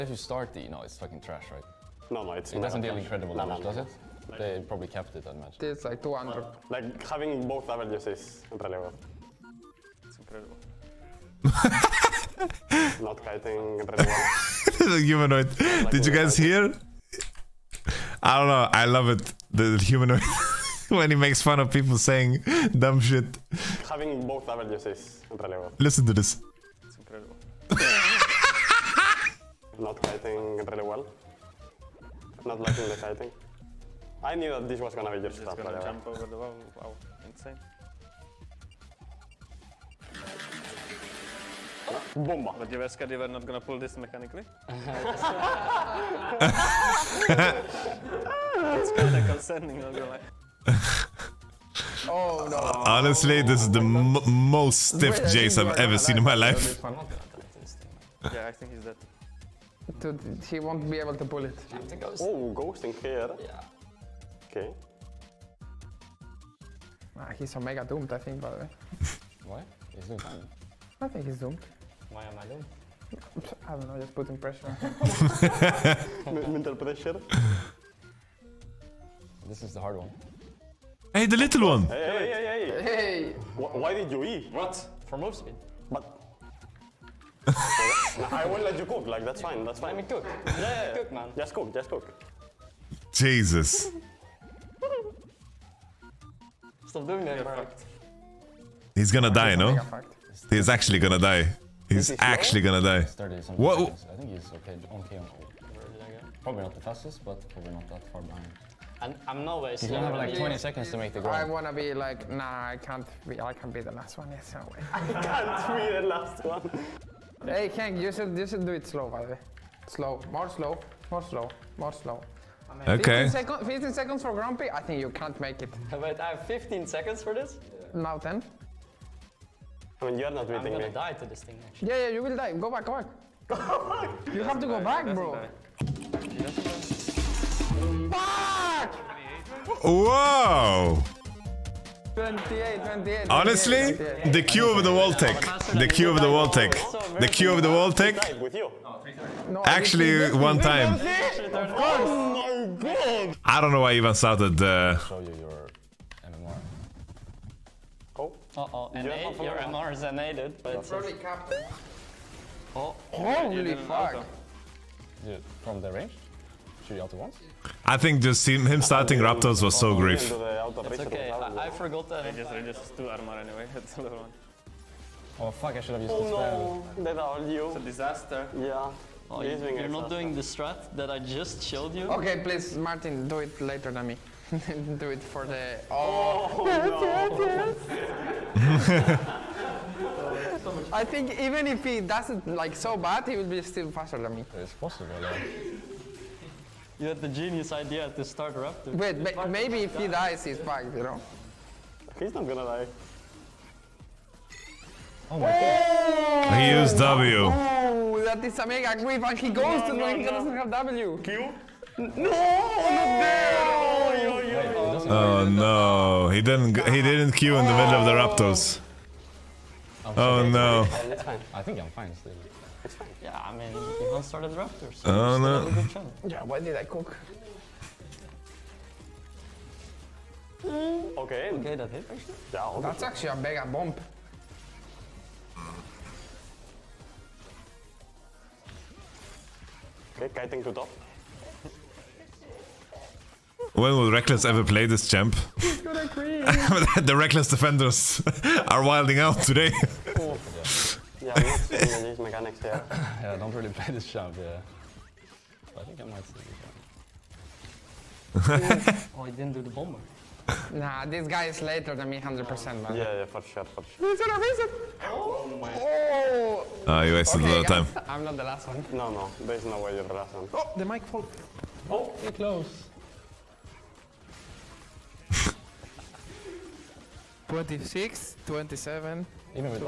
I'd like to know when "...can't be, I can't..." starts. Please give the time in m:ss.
1:52.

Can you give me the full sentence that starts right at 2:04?
I think you can't make it.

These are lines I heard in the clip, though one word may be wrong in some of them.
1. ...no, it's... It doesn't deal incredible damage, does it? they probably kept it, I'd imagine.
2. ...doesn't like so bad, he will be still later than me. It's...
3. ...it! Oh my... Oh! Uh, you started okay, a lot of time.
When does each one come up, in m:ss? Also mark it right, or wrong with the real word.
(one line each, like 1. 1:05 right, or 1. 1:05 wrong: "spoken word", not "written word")
1. 0:02 right
2. 3:12 wrong: "faster", not "later"
3. 4:24 wrong: "wasted", not "started".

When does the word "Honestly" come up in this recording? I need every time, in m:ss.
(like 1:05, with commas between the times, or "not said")
0:52, 2:22.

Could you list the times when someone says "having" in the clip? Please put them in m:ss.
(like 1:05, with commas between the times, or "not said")
0:07, 0:23.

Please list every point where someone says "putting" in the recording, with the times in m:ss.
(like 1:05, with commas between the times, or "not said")
1:14.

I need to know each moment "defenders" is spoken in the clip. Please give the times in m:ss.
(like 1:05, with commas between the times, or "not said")
4:07.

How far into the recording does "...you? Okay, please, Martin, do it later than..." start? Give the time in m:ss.
3:01.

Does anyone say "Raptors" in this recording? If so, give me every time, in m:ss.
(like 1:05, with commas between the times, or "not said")
2:49, 3:18, 3:38, 3:44.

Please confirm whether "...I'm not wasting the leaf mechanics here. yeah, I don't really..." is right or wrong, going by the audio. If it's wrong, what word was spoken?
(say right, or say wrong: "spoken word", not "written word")
wrong: "seeing", not "wasting".